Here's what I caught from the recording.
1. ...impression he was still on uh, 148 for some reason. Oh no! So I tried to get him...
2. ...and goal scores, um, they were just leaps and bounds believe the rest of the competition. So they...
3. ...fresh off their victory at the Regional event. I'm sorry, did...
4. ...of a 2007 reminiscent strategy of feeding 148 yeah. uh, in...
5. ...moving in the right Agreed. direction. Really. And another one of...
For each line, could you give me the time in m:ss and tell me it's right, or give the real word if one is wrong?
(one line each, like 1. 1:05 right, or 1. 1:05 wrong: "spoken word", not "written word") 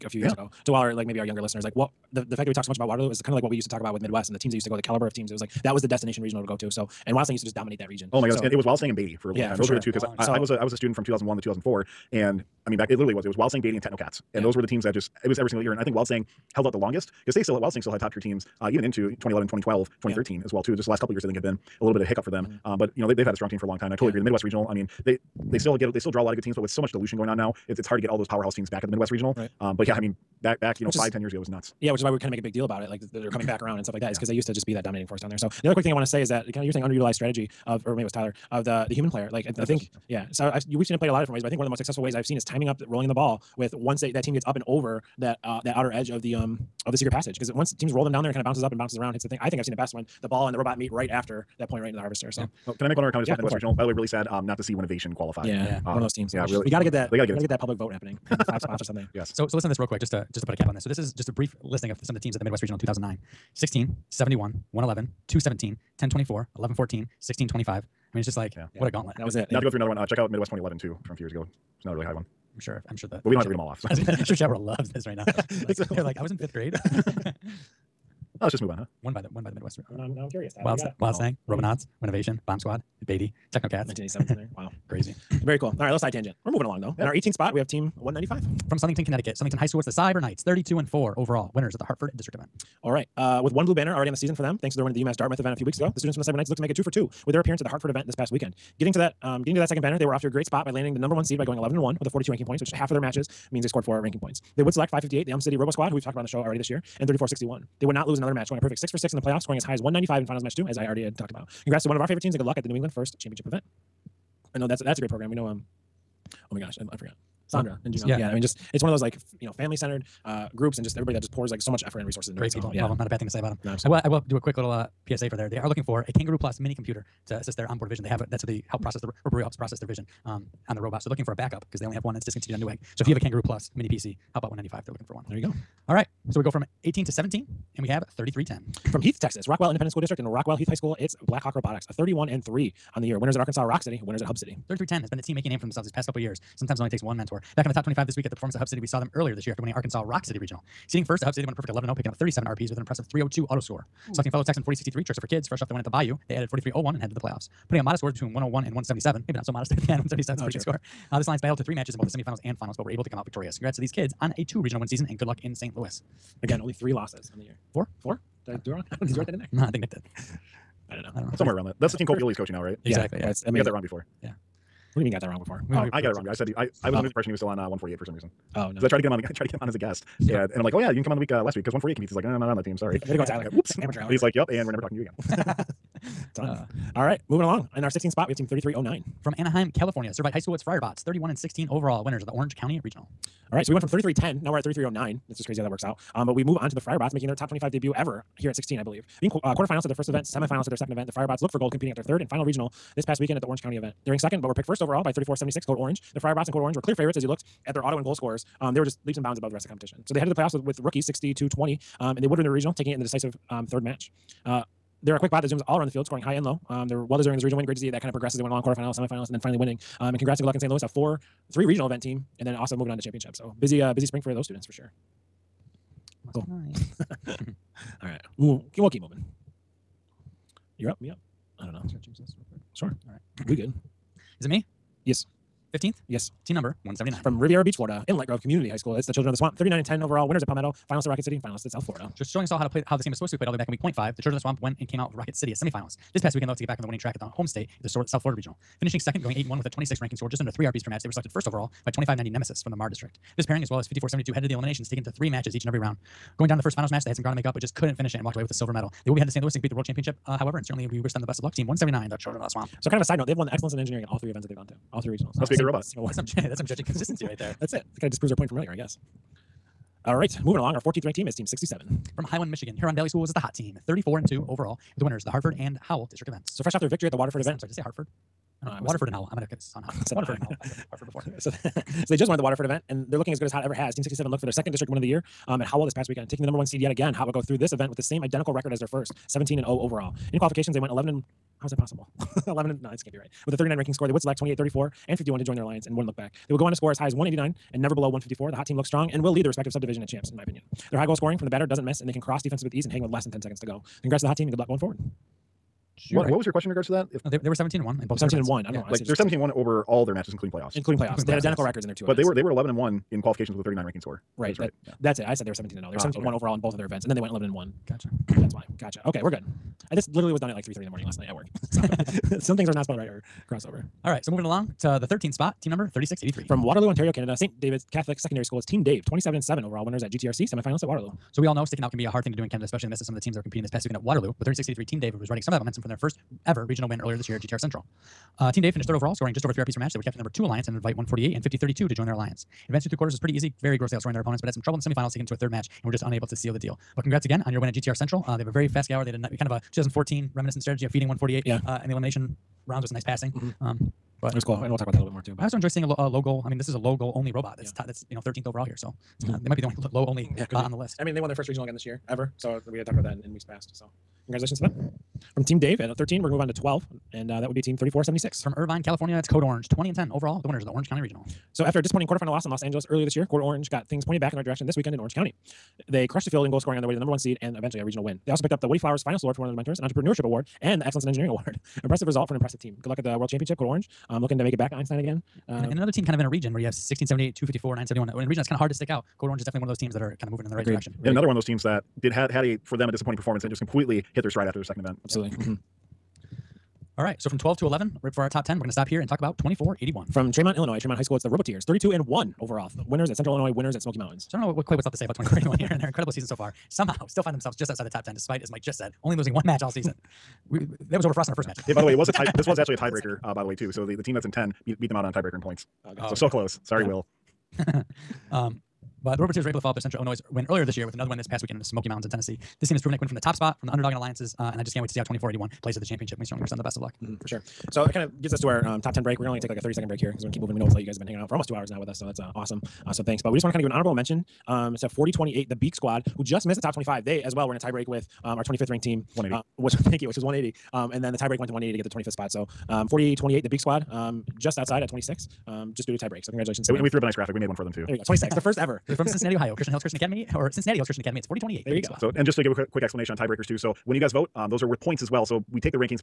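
1. 2:57 right
2. 3:27 wrong: "above", not "believe"
3. 4:36 wrong: "Waterford", not "Regional"
4. 5:49 wrong: "2014", not "2007"
5. 6:30 right.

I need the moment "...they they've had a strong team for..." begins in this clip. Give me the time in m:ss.
0:23.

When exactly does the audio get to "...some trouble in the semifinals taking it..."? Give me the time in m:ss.
5:44.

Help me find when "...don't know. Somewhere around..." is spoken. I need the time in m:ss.
2:51.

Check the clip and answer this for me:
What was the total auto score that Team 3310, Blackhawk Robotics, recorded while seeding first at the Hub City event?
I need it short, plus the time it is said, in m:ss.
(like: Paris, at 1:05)
302, at 2:33.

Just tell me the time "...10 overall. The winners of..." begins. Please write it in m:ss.
6:09.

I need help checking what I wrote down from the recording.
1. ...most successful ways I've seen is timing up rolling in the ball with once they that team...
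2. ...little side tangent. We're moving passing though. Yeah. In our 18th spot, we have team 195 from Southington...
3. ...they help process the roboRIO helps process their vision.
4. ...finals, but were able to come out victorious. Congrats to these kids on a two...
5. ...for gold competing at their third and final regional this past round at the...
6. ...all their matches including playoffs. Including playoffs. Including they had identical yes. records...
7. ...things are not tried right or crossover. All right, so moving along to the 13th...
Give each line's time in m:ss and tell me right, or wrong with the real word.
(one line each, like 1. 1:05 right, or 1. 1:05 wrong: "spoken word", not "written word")
1. 0:41 right
2. 1:25 wrong: "along", not "passing"
3. 2:08 right
4. 2:42 right
5. 3:21 wrong: "weekend", not "round"
6. 5:09 right
7. 5:22 wrong: "spelled", not "tried".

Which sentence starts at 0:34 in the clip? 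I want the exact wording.
they used to just be that dominating force down there.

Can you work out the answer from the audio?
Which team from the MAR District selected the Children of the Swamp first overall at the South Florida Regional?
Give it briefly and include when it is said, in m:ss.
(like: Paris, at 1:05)
Nemesis, at 4:11.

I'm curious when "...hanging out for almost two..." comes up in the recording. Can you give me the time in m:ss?
7:11.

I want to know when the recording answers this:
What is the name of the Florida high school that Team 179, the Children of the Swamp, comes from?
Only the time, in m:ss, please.
3:58.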